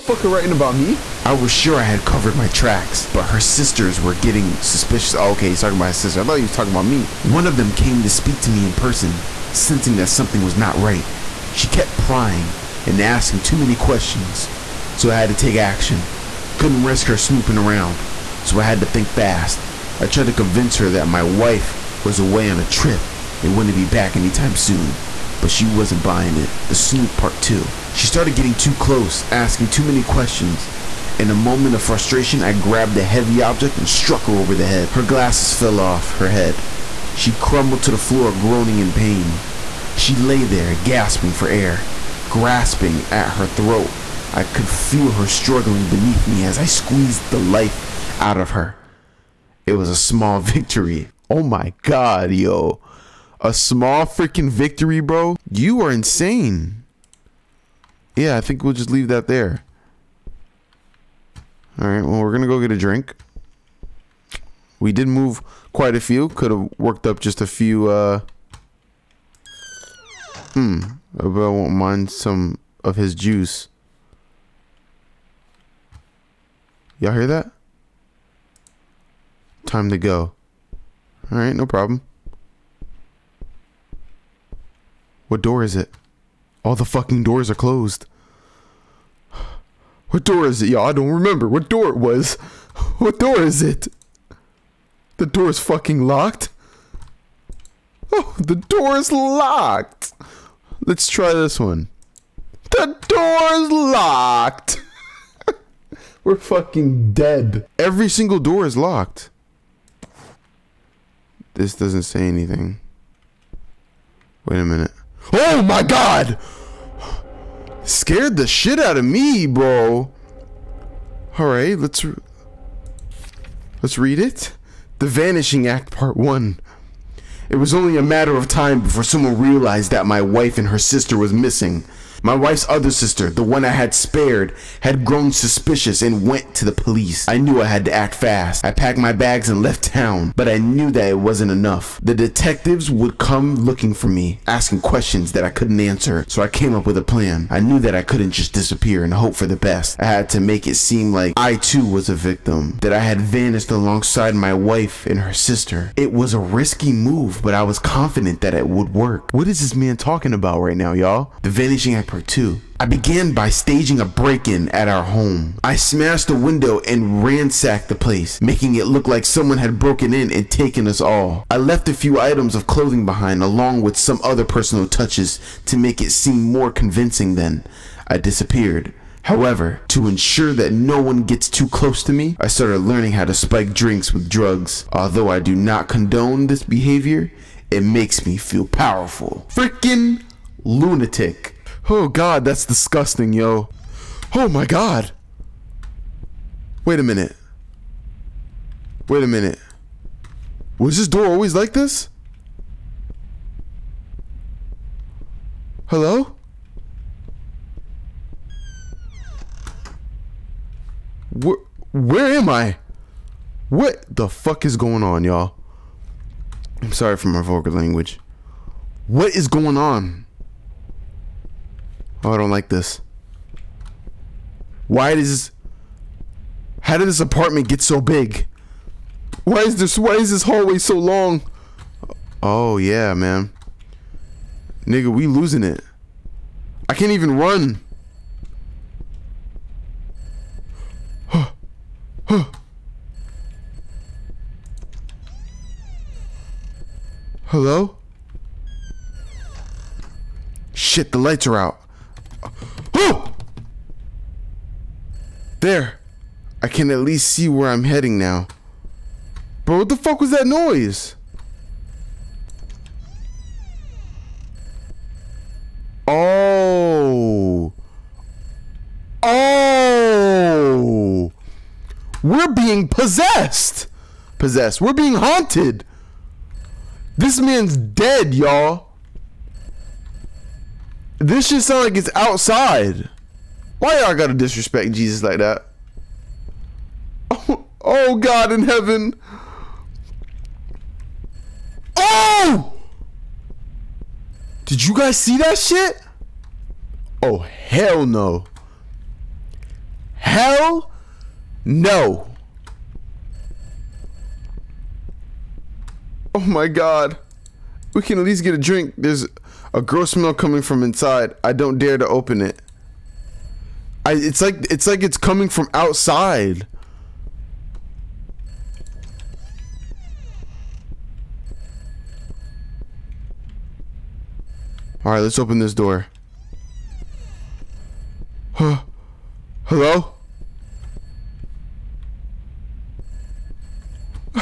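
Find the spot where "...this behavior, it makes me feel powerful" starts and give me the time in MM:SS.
03:06.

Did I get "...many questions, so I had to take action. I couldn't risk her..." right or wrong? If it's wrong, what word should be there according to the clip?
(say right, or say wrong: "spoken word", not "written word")
right.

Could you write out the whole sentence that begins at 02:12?
My wife's other sister, the one I had spared, had grown suspicious and went to the police.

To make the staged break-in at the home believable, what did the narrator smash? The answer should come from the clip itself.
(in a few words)
The window.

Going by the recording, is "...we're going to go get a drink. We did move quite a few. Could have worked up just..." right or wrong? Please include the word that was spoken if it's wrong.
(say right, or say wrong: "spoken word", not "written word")
right.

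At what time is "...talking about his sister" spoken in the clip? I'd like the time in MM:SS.
00:05.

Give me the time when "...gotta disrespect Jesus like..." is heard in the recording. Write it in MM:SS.
04:44.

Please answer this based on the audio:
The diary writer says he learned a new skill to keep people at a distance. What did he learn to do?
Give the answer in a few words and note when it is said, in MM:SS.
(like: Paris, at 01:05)
Spike drinks with drugs, at 03:03.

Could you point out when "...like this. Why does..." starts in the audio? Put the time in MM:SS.
03:42.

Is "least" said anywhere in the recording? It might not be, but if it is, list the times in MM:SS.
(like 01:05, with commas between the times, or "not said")
04:16, 05:08.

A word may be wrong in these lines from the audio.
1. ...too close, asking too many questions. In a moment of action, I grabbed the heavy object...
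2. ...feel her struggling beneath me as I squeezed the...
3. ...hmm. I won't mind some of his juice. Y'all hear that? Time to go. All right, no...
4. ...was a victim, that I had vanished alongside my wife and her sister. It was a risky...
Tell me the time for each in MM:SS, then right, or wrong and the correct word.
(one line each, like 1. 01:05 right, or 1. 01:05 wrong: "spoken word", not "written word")
1. 00:28 wrong: "frustration", not "action"
2. 00:44 right
3. 01:10 right
4. 02:31 right.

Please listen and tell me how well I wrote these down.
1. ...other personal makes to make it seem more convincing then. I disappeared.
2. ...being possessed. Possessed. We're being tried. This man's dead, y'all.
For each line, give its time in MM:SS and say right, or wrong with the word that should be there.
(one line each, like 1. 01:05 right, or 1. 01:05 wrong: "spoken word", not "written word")
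1. 02:54 wrong: "touches", not "makes"
2. 04:32 wrong: "haunted", not "tried".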